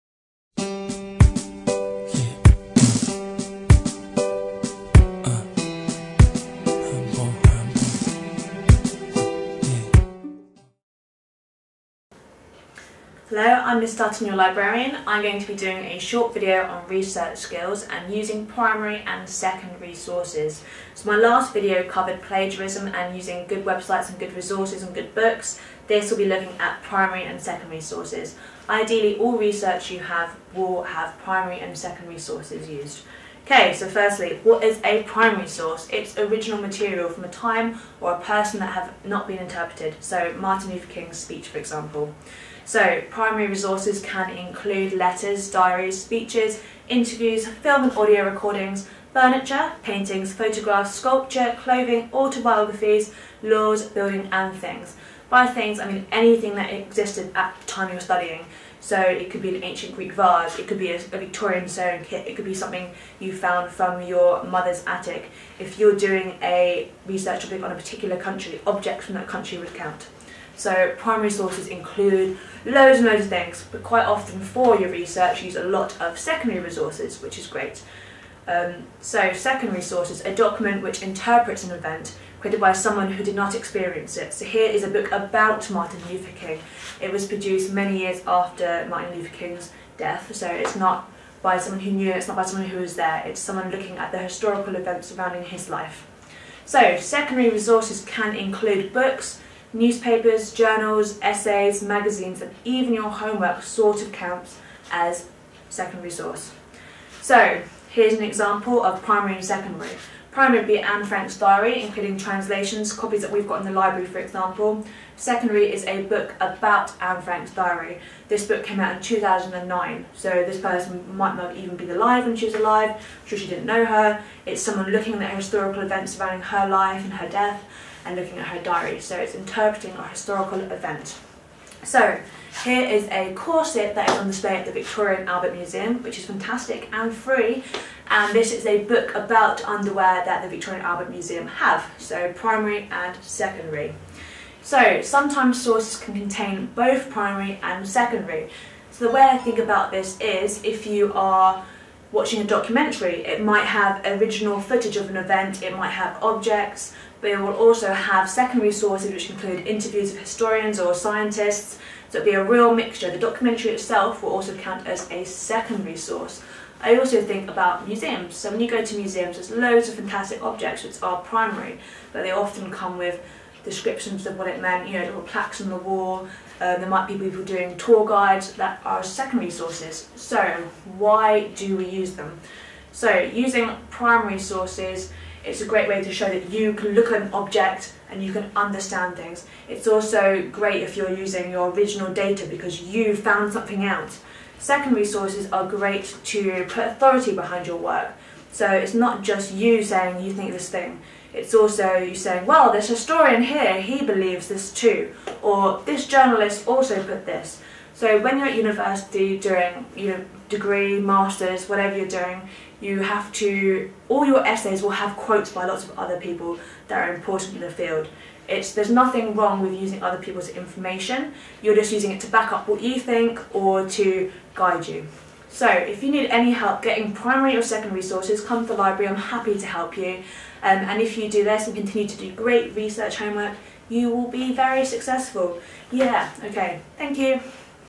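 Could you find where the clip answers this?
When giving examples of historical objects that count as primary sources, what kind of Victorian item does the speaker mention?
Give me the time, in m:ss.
1:01.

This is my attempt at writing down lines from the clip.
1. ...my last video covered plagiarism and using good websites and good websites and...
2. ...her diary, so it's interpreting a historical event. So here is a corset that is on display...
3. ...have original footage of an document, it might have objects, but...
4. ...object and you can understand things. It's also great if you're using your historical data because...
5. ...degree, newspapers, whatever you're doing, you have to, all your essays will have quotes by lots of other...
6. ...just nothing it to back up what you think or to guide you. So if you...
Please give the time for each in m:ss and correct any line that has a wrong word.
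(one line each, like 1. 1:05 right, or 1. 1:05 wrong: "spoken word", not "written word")
1. 0:21 wrong: "resources", not "websites"
2. 2:08 right
3. 2:33 wrong: "event", not "document"
4. 3:07 wrong: "original", not "historical"
5. 3:30 wrong: "masters", not "newspapers"
6. 3:41 wrong: "using", not "nothing".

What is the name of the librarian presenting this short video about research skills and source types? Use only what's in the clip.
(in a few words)
Miss Dutton.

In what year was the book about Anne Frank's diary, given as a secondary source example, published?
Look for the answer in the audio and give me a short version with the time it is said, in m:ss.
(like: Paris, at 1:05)
2009, at 1:59.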